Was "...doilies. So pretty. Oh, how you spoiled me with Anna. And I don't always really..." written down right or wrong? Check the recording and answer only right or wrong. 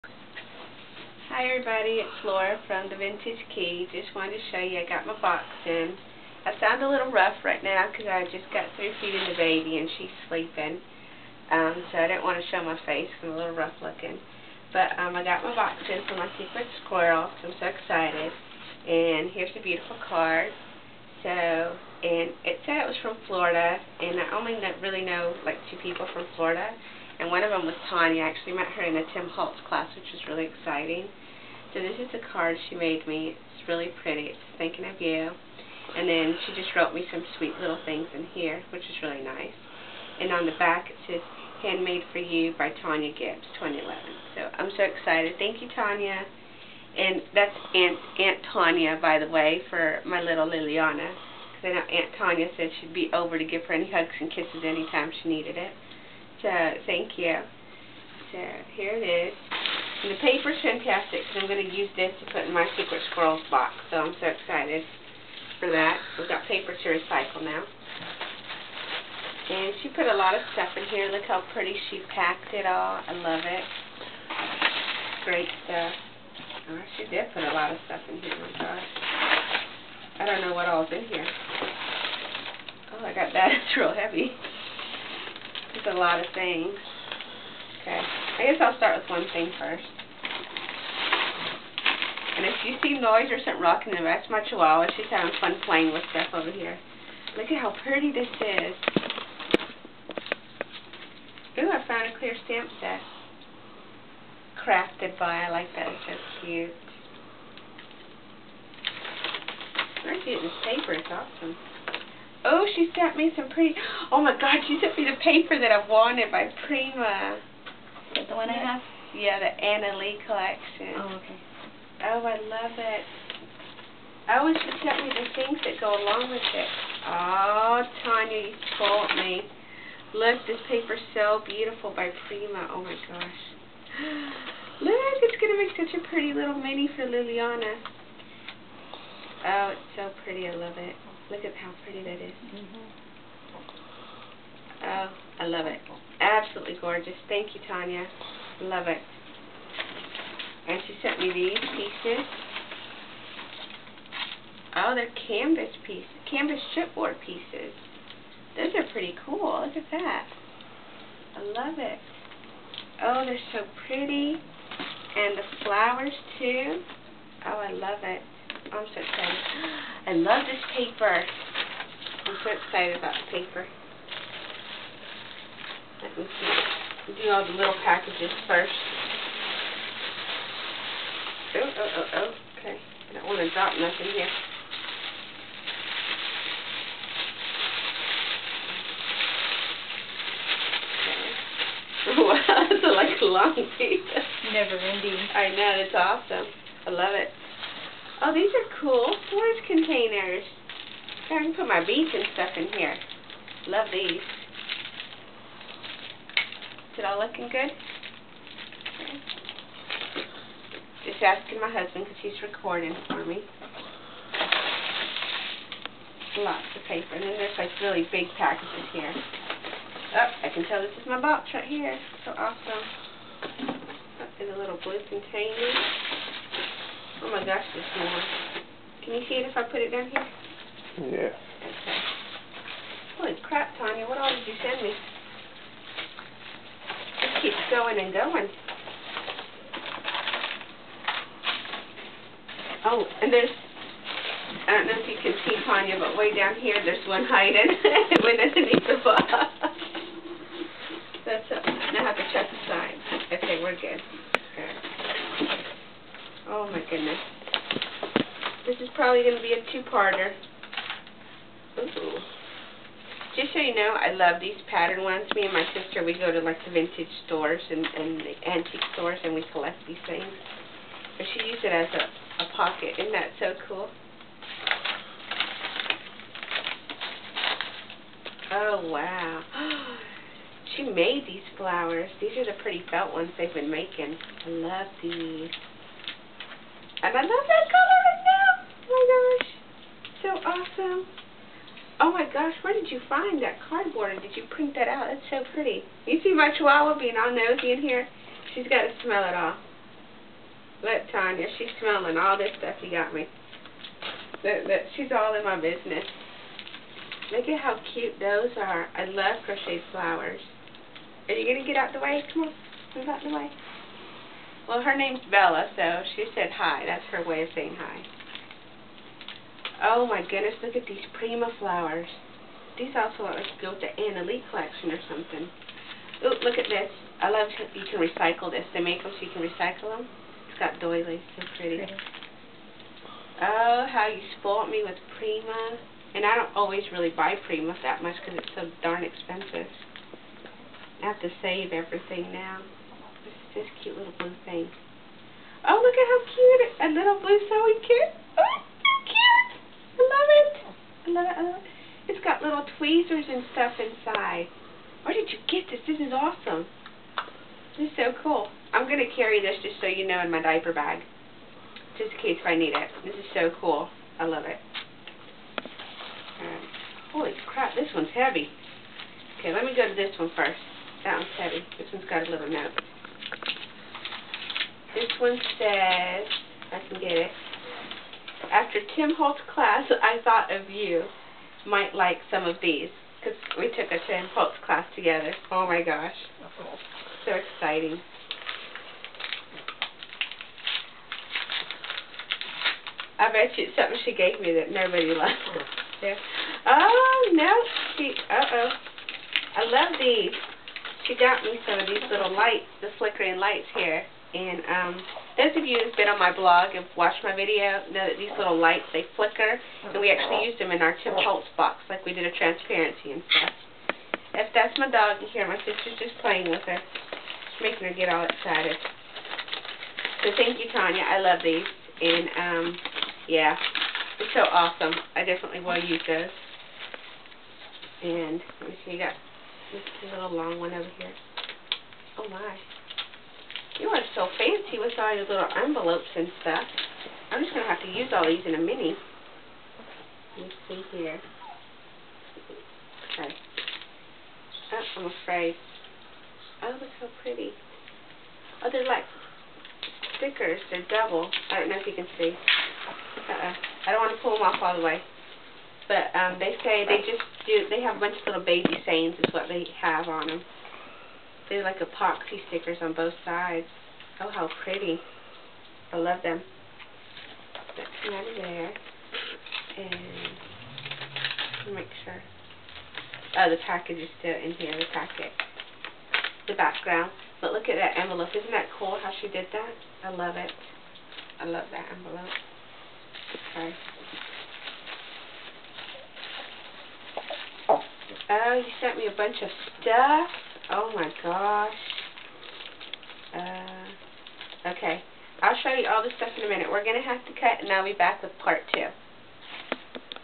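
wrong.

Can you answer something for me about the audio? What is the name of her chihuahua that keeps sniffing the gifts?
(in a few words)
Bella.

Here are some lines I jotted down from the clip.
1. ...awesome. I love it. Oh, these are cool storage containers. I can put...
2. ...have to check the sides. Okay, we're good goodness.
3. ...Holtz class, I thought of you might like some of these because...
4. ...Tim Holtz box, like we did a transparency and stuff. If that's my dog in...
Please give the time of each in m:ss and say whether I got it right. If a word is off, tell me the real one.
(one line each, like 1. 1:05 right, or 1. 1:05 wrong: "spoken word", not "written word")
1. 3:15 right
2. 4:12 right
3. 6:19 right
4. 6:51 right.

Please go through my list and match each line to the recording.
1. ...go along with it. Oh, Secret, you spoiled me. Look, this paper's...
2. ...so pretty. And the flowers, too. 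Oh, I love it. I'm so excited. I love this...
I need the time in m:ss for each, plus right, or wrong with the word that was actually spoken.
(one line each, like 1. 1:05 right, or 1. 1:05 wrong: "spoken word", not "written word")
1. 2:05 wrong: "Tonya", not "Secret"
2. 2:43 right.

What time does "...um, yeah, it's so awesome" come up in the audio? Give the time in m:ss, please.
7:02.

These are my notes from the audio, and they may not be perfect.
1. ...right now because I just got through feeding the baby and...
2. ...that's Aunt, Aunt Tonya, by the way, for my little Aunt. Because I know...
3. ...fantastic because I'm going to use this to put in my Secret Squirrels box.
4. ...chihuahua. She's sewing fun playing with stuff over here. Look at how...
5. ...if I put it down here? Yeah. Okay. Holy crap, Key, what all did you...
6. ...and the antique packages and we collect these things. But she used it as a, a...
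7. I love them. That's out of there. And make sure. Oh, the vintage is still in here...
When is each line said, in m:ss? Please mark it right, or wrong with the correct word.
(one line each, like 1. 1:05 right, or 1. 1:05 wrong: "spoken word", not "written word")
1. 0:07 right
2. 0:47 wrong: "Liliana", not "Aunt"
3. 1:00 right
4. 1:34 wrong: "having", not "sewing"
5. 3:49 wrong: "Tonya", not "Key"
6. 4:27 wrong: "stores", not "packages"
7. 7:45 wrong: "package", not "vintage".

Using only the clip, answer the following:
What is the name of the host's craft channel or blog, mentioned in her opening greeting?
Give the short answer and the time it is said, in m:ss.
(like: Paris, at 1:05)
The Vintage Key, at 0:02.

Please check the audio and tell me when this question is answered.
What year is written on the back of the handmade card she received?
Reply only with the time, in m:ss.
0:43.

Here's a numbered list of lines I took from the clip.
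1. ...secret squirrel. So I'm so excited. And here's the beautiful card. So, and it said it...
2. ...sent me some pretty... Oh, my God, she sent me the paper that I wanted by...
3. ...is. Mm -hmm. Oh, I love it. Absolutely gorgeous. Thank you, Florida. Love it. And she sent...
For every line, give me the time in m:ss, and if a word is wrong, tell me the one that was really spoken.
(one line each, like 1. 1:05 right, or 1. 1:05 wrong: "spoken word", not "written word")
1. 0:16 right
2. 1:52 right
3. 2:22 wrong: "Tonya", not "Florida".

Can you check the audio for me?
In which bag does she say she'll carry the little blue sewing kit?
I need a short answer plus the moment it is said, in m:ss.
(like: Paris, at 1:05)
diaper bag, at 6:00.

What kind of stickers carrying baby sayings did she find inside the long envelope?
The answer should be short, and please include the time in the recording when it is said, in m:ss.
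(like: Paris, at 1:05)
epoxy stickers, at 7:41.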